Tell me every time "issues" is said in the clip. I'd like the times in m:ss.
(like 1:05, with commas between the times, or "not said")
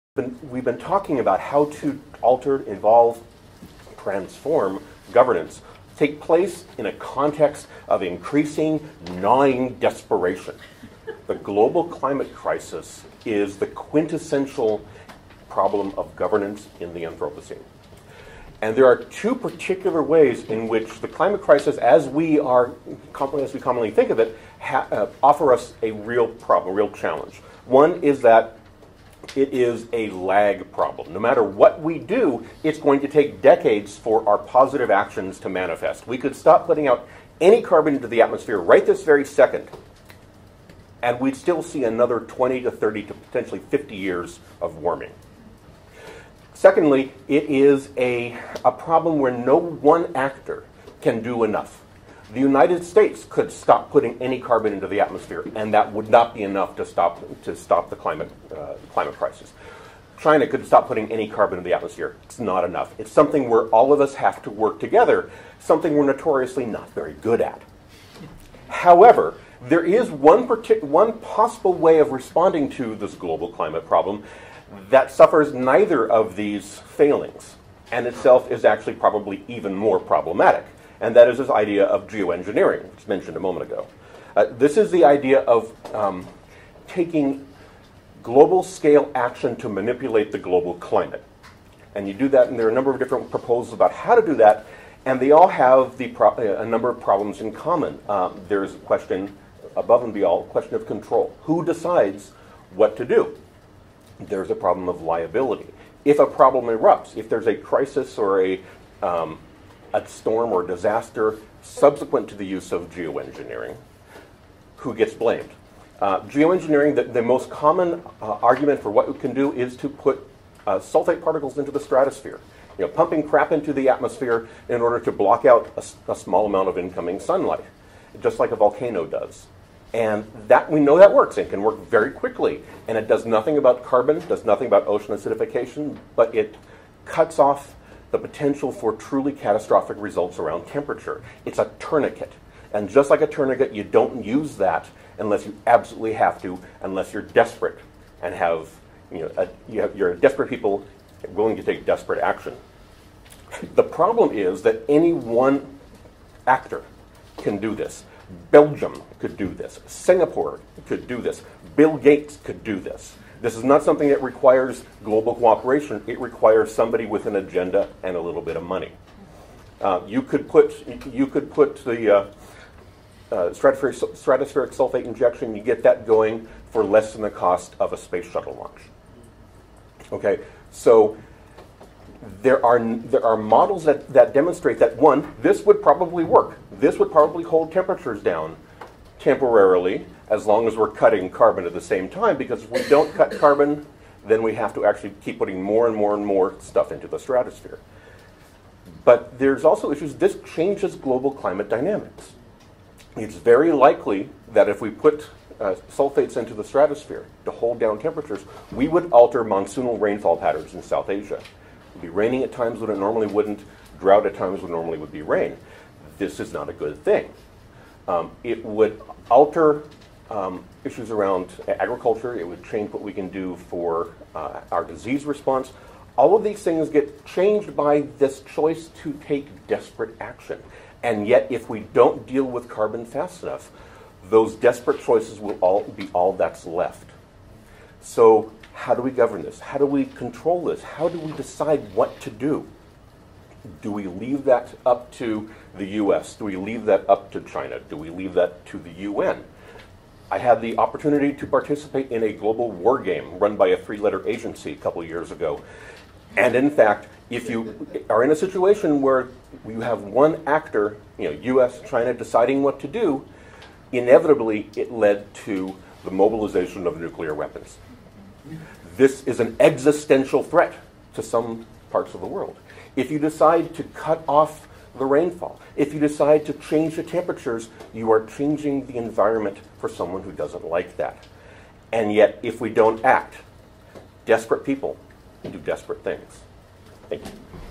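3:19, 3:40.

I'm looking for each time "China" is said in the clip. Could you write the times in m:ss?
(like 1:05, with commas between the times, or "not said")
1:00, 4:07, 4:21.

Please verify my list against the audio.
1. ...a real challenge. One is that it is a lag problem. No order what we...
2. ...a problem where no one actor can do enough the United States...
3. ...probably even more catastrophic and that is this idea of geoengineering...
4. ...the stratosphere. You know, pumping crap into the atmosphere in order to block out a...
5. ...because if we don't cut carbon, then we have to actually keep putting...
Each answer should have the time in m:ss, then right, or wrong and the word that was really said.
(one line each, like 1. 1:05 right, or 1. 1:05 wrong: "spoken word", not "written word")
1. 0:26 wrong: "matter", not "order"
2. 0:48 right
3. 1:18 wrong: "problematic", not "catastrophic"
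4. 2:01 right
5. 3:12 right.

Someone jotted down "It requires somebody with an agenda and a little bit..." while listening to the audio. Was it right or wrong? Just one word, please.
right.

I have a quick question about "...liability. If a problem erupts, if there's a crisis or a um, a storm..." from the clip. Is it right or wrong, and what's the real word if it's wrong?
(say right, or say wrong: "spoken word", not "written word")
right.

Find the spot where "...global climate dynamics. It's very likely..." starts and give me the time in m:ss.
3:20.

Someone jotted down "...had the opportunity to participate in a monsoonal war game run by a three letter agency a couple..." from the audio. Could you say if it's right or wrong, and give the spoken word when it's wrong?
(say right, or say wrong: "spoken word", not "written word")
wrong: "global", not "monsoonal".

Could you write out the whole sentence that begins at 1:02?
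It's something where all of us have to work together, something we're notoriously not very good at.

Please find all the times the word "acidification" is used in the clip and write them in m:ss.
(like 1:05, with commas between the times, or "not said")
2:15.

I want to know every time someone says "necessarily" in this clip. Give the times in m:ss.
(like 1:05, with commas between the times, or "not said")
not said.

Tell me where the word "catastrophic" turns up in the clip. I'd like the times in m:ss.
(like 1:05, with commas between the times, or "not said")
2:19.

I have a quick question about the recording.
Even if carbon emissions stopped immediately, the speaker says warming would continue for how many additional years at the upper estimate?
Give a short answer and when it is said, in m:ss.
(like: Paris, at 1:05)
50, at 0:43.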